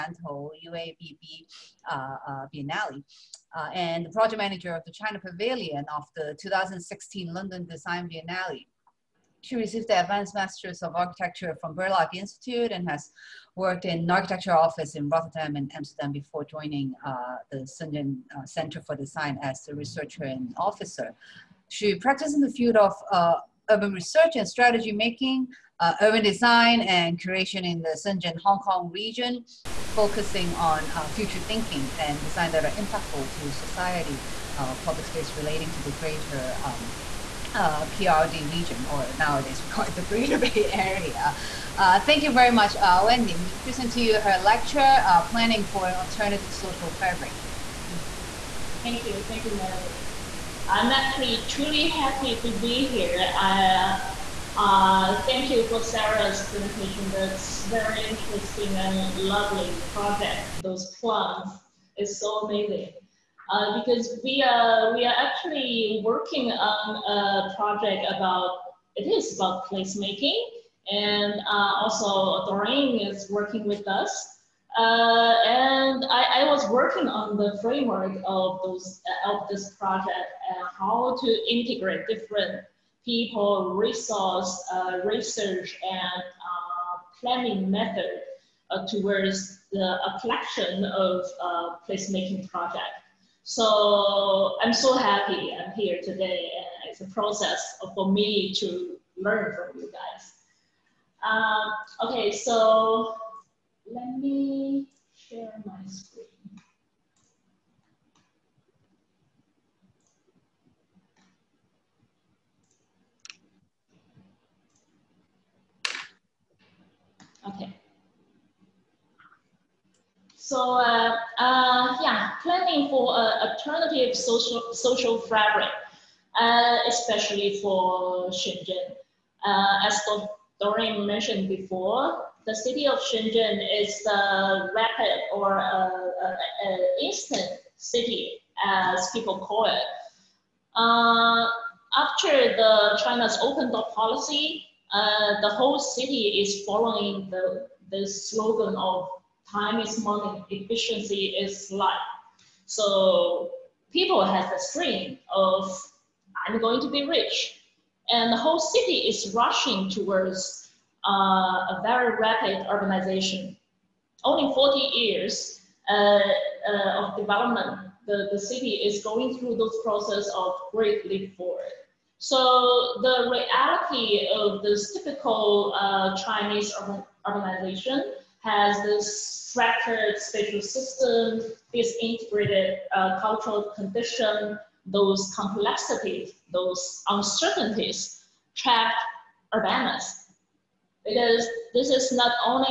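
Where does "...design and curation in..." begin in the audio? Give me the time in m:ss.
0:26.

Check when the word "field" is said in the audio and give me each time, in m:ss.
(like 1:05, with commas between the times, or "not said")
0:22.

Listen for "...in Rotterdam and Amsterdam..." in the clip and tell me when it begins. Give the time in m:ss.
0:14.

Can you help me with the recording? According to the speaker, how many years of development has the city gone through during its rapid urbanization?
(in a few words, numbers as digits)
40.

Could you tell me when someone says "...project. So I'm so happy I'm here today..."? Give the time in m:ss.
1:32.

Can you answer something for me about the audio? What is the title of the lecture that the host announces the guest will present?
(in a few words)
Planning for an Alternative Social Fabric.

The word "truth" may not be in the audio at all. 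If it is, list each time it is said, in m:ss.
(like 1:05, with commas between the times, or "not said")
not said.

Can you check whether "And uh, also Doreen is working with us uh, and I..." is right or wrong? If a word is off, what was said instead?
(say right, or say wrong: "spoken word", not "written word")
right.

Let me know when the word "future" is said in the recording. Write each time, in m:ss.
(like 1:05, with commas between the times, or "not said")
0:31.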